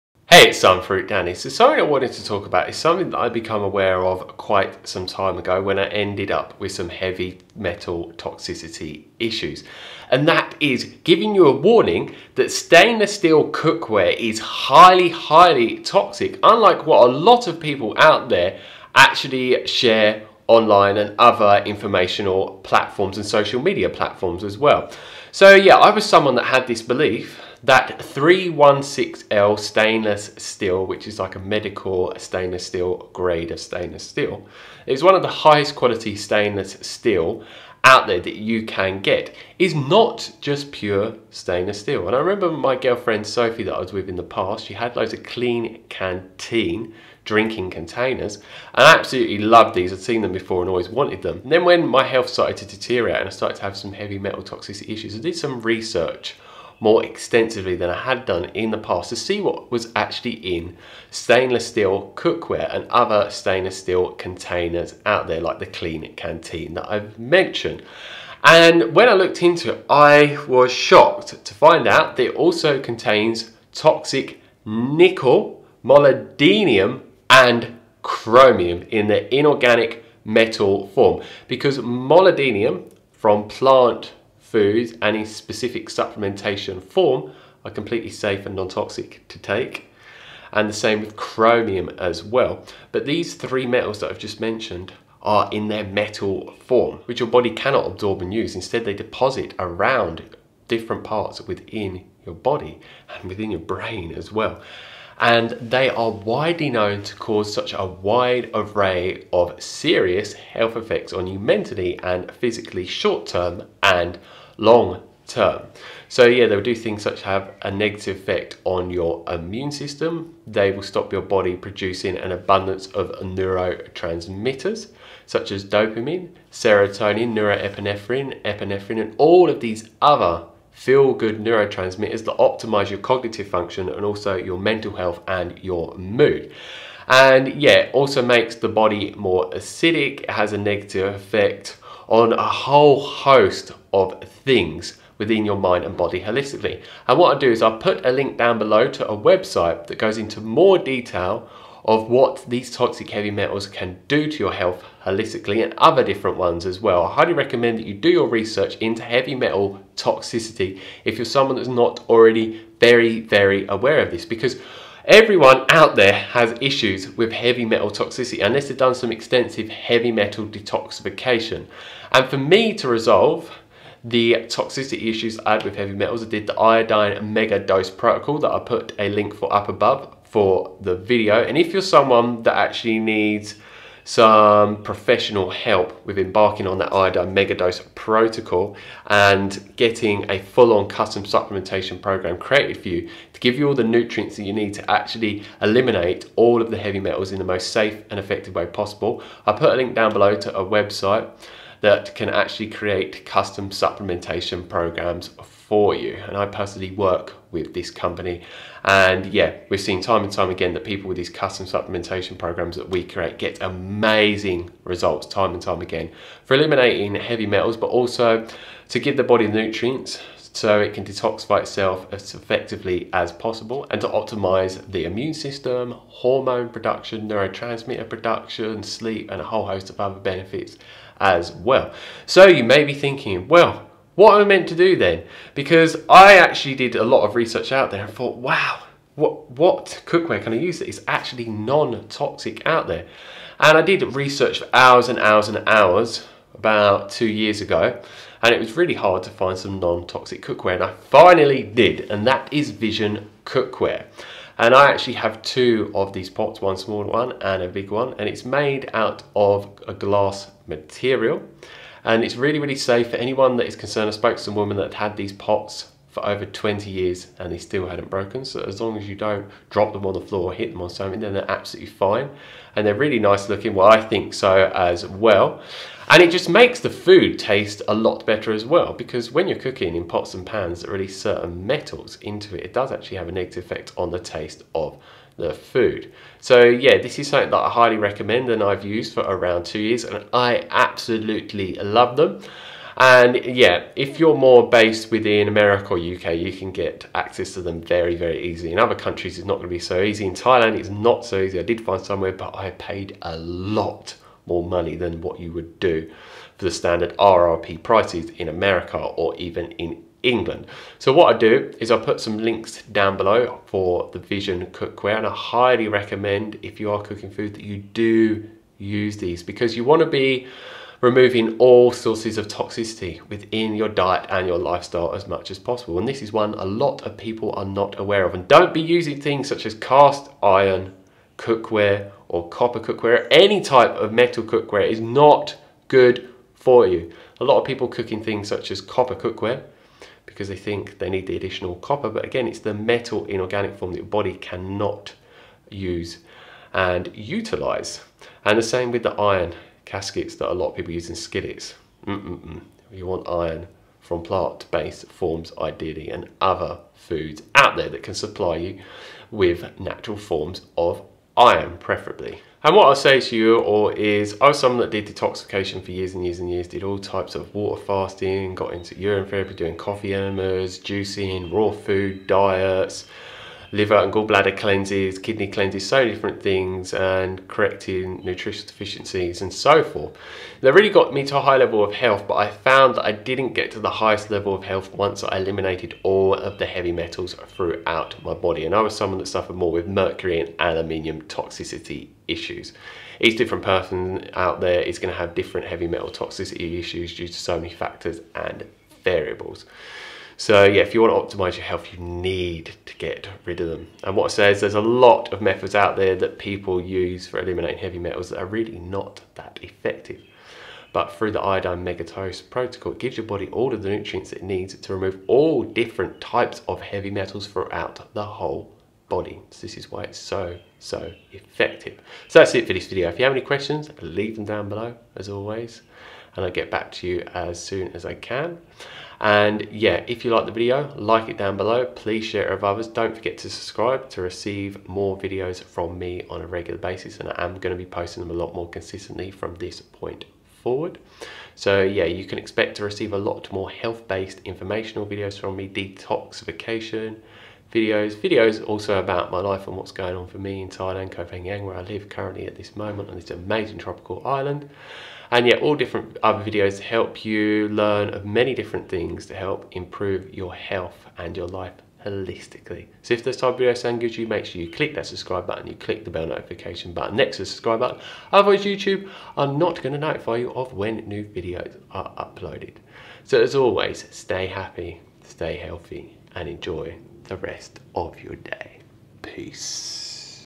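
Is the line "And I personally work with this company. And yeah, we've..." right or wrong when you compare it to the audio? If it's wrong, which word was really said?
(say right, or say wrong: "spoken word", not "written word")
right.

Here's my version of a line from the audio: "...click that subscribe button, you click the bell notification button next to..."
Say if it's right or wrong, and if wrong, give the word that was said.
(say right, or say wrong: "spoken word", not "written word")
right.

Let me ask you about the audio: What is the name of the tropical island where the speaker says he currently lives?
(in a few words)
Koh Phangan.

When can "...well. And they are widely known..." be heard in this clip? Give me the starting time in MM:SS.
01:44.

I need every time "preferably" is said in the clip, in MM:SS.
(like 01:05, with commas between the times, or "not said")
06:01.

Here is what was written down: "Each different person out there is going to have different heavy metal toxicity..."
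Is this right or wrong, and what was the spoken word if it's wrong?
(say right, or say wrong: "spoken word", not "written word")
right.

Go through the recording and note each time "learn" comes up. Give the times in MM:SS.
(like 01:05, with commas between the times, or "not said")
07:37.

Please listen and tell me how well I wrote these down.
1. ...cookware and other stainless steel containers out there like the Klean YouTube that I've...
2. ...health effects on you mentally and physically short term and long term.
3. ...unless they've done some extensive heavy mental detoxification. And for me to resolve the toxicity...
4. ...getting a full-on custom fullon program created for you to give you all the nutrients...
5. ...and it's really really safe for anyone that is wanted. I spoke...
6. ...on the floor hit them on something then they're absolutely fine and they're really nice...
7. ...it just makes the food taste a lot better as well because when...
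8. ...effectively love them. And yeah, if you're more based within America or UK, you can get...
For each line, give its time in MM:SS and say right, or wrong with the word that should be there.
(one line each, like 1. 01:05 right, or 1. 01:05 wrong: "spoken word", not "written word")
1. 01:02 wrong: "Kanteen", not "YouTube"
2. 01:50 right
3. 02:48 wrong: "metal", not "mental"
4. 03:09 wrong: "supplementation", not "fullon"
5. 04:22 wrong: "concerned", not "wanted"
6. 04:30 right
7. 04:36 right
8. 04:50 wrong: "absolutely", not "effectively".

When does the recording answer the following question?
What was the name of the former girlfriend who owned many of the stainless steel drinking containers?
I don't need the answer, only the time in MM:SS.
00:43.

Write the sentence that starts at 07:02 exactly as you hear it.
So that's it for this video.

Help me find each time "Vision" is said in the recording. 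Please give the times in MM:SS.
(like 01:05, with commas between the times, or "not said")
04:12, 05:14.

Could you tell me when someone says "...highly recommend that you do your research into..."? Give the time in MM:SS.
02:37.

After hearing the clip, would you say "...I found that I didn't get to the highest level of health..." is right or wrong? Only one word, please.
right.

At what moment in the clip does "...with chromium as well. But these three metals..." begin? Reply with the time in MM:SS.
01:30.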